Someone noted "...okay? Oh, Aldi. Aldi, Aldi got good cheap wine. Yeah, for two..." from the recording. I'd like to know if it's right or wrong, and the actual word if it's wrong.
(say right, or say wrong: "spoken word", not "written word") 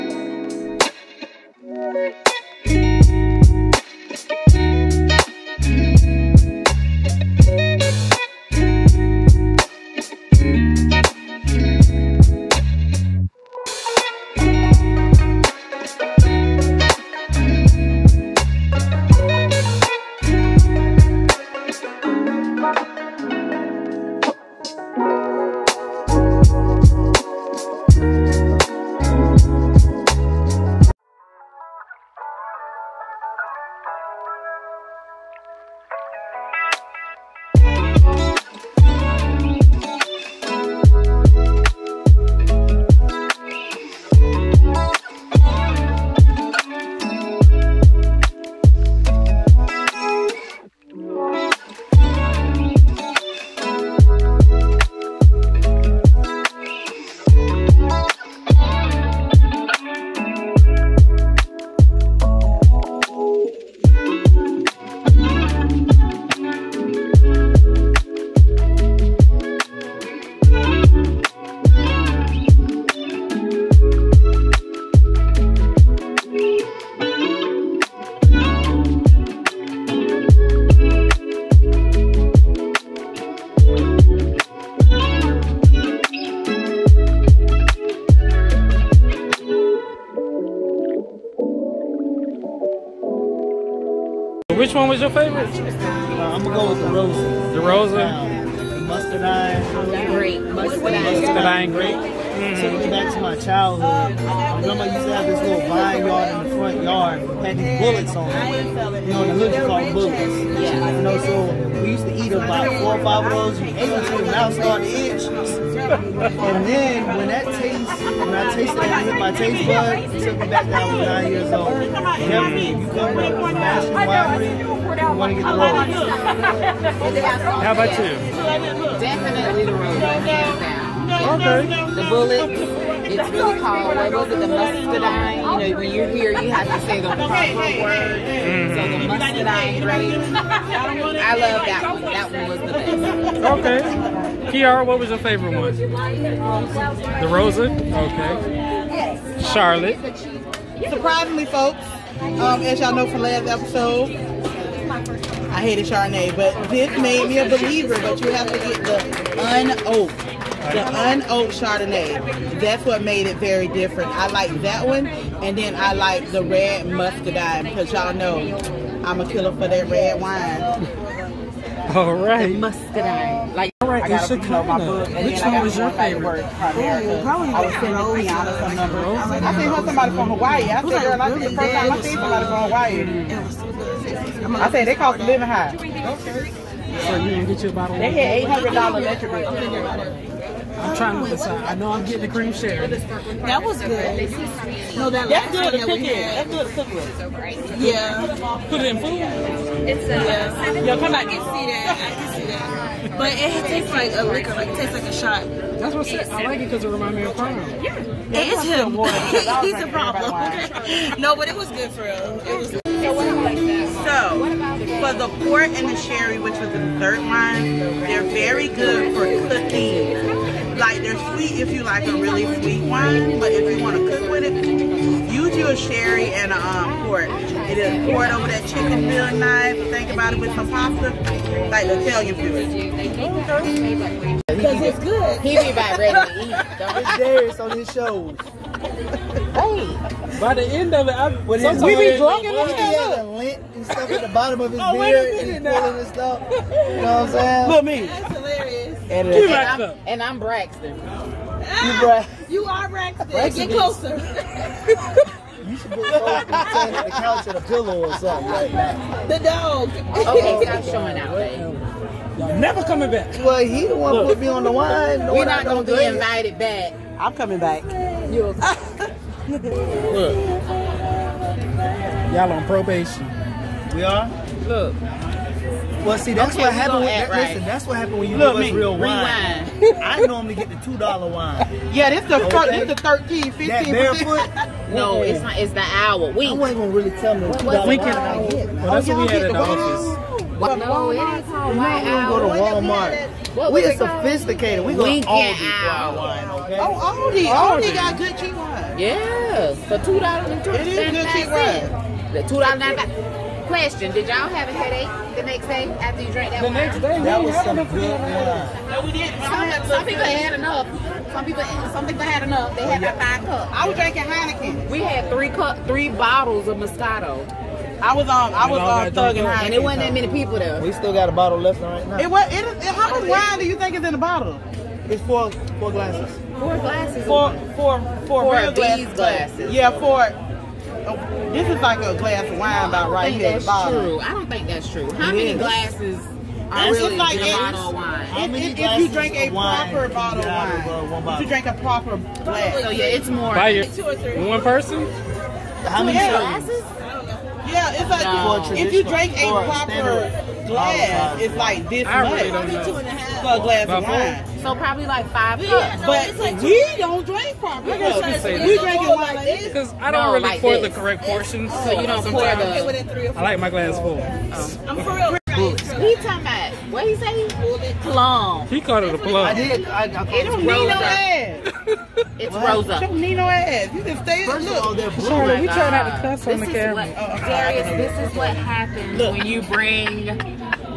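right.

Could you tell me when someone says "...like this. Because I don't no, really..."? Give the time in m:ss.
5:59.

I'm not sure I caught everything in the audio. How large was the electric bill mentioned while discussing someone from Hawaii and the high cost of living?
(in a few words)
$800.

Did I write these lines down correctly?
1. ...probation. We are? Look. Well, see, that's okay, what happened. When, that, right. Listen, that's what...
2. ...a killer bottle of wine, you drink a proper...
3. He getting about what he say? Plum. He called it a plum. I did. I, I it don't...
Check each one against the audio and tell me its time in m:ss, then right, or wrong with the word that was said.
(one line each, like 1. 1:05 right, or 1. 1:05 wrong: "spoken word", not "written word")
1. 4:32 right
2. 5:39 wrong: "proper", not "killer"
3. 6:06 wrong: "talking", not "getting".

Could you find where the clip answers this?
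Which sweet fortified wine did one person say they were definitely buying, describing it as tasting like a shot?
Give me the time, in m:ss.
3:12.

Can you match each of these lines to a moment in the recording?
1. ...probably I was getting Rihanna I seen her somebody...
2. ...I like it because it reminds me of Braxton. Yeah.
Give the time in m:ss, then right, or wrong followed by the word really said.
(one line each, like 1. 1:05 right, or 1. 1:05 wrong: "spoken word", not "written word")
1. 2:57 wrong: "sending", not "getting"
2. 3:26 wrong: "Prime", not "Braxton".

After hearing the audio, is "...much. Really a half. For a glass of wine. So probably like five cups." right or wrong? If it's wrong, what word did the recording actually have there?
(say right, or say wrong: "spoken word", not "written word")
right.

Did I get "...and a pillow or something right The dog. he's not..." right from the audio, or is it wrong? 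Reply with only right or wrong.
right.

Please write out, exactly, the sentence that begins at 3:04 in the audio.
I said, they cost a living high.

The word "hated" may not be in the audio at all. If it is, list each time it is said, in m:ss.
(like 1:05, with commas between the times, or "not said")
2:35.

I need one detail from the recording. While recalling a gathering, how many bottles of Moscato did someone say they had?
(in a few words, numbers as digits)
3.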